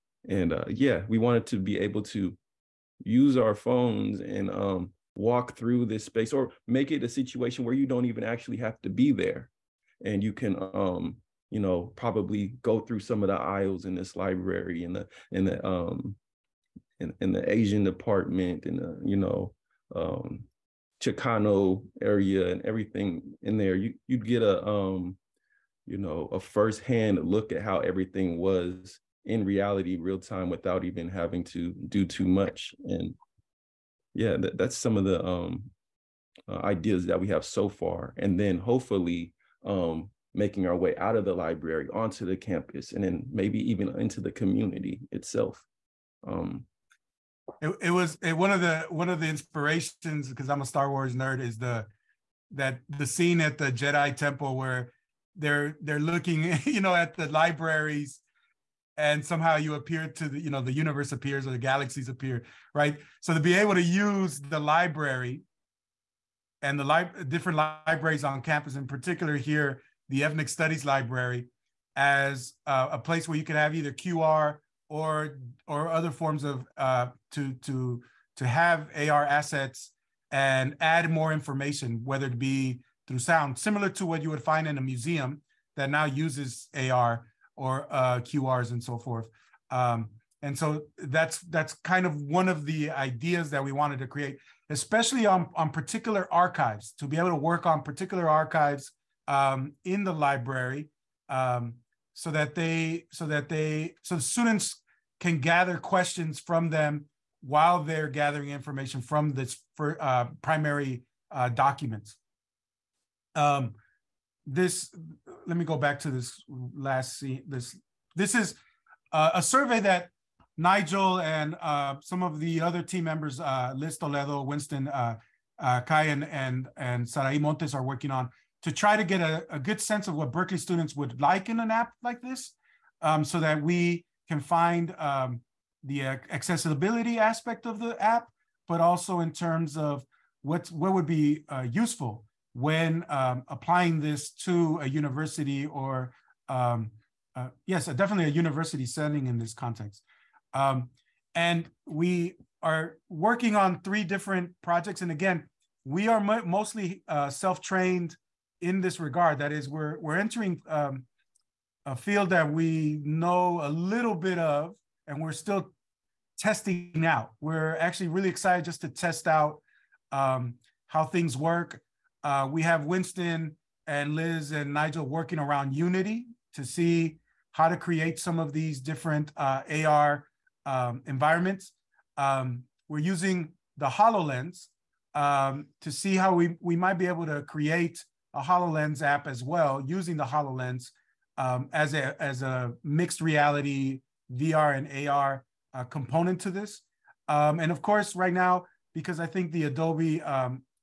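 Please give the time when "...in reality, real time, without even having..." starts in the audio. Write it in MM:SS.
00:29.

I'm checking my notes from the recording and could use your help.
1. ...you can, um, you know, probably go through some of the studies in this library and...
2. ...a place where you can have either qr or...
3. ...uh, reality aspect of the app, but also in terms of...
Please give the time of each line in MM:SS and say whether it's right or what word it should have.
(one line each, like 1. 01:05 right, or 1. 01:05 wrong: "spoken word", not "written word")
1. 00:10 wrong: "aisles", not "studies"
2. 01:12 right
3. 02:16 wrong: "accessibility", not "reality".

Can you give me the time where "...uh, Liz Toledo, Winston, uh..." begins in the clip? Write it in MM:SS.
02:03.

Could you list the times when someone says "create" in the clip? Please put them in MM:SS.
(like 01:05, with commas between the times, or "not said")
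01:34, 02:57, 03:07.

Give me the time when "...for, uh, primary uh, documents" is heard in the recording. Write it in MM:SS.
01:49.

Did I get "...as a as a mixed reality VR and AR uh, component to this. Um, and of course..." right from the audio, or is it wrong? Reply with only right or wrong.
right.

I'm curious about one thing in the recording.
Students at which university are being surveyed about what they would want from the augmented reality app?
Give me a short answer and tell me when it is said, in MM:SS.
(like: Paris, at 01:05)
Berkeley, at 02:10.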